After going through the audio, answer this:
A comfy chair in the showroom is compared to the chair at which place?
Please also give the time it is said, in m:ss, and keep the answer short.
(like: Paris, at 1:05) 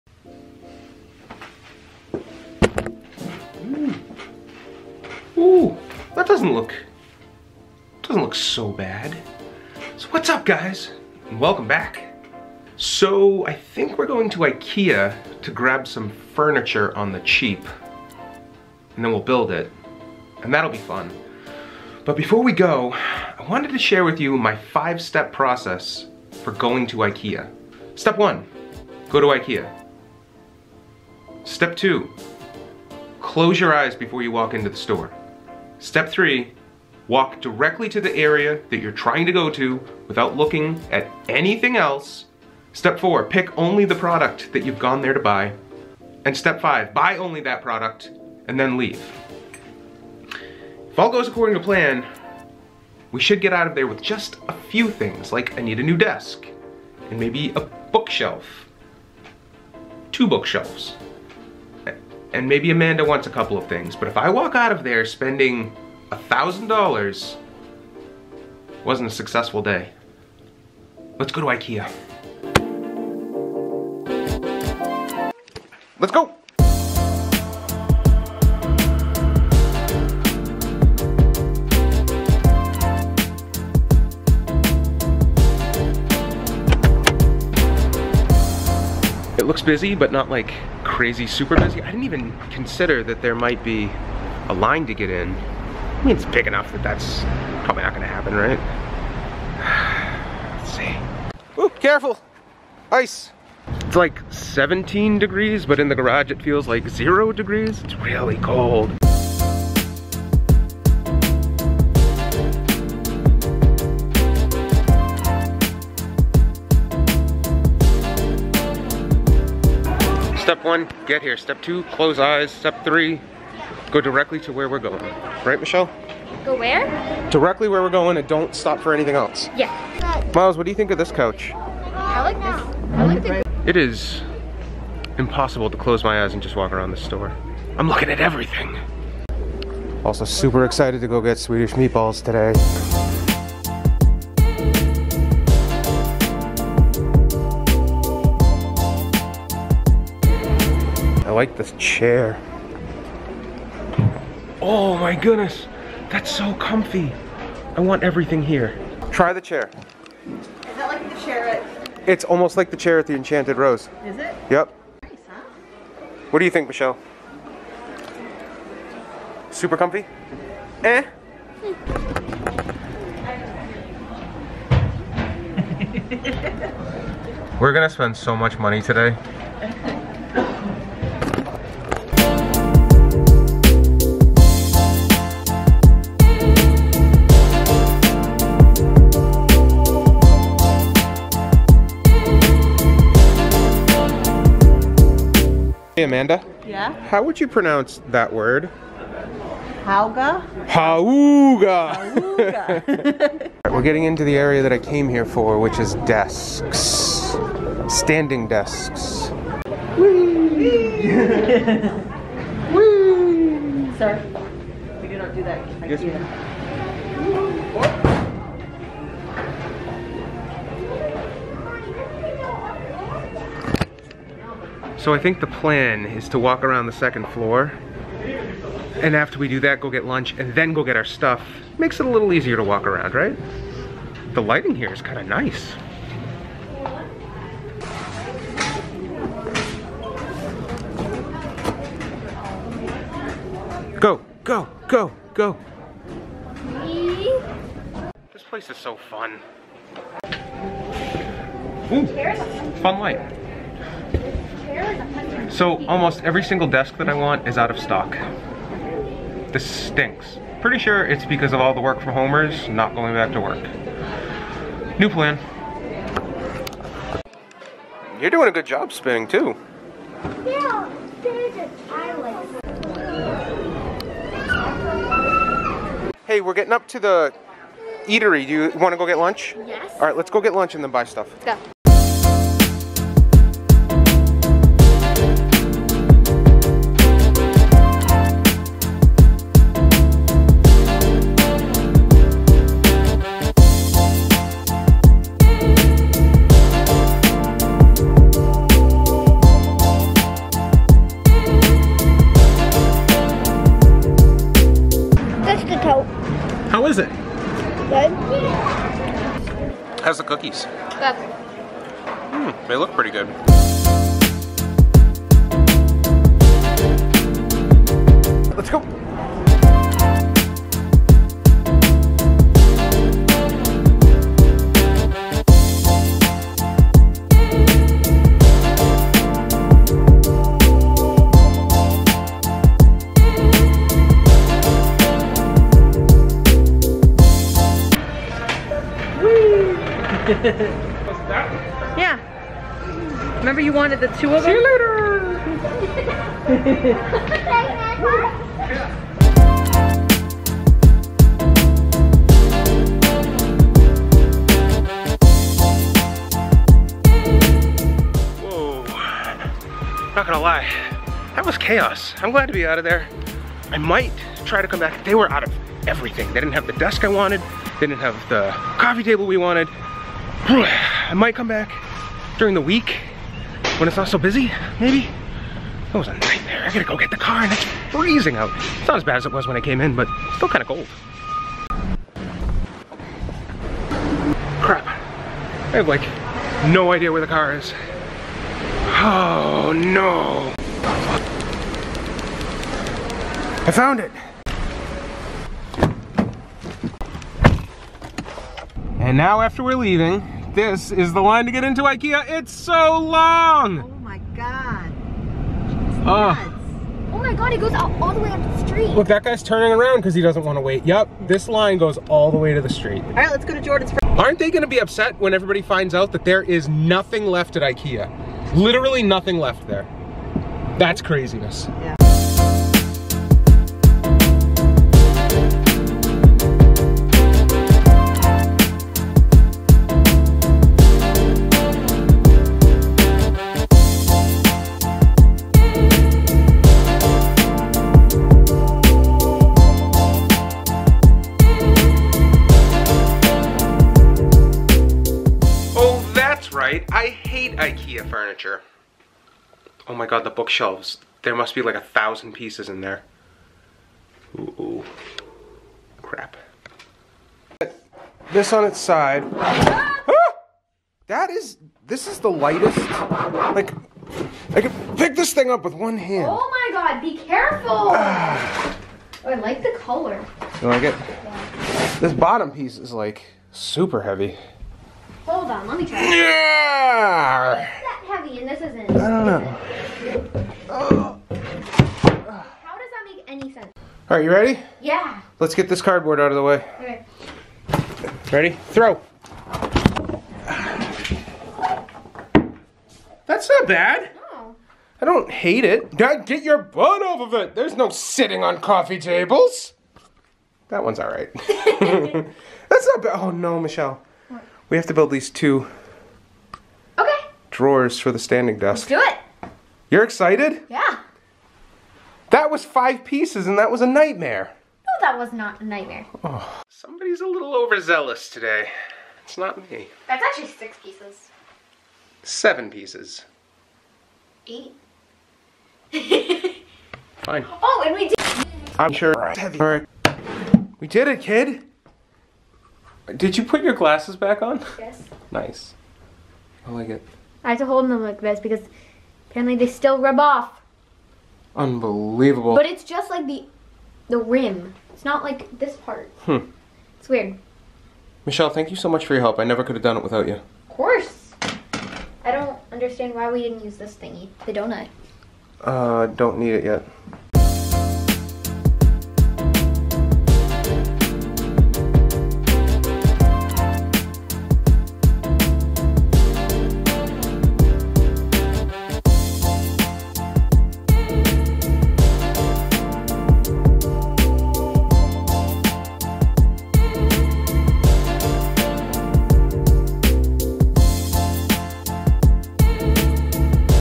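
the Enchanted Rose, at 2:43.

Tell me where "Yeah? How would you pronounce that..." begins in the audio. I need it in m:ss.
3:16.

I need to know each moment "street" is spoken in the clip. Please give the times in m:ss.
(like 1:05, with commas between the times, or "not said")
6:48, 6:52.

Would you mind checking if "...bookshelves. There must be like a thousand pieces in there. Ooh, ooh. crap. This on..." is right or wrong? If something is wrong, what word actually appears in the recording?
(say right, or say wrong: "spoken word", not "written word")
right.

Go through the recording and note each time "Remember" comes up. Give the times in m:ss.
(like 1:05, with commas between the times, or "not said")
5:43.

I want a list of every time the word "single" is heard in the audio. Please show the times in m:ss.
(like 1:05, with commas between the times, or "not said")
4:16.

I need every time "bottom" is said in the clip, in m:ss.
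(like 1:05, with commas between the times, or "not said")
7:52.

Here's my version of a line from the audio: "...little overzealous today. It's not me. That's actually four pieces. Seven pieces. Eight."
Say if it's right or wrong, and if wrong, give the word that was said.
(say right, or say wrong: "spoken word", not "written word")
wrong: "six", not "four".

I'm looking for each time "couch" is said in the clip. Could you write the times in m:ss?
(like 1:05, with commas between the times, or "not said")
2:11.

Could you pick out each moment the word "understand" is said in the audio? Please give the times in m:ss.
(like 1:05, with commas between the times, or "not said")
9:12.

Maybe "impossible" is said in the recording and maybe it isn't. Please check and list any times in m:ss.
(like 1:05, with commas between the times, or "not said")
2:15.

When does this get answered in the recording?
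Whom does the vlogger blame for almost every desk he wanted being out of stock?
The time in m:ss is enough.
4:21.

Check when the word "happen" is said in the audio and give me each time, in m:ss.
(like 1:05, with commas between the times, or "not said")
1:38.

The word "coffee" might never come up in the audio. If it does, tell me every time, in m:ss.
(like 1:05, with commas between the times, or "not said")
6:08, 8:18.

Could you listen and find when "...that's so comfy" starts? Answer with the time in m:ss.
2:36.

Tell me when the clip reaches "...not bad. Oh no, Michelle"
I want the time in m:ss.
8:22.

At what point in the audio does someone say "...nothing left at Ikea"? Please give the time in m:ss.
6:56.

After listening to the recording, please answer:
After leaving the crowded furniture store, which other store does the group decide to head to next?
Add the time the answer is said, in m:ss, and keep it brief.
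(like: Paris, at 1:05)
Jordan's, at 6:53.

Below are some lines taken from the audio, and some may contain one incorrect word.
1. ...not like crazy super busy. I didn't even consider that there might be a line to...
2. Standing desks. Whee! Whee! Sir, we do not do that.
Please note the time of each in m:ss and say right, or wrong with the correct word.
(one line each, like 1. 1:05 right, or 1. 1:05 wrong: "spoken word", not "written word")
1. 1:30 right
2. 3:27 right.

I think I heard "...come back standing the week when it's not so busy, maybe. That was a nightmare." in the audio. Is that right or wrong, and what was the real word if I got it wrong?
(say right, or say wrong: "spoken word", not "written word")
wrong: "during", not "standing".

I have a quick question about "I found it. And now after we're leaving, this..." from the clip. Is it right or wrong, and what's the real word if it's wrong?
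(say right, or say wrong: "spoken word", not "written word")
right.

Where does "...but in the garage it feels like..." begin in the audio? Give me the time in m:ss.
1:45.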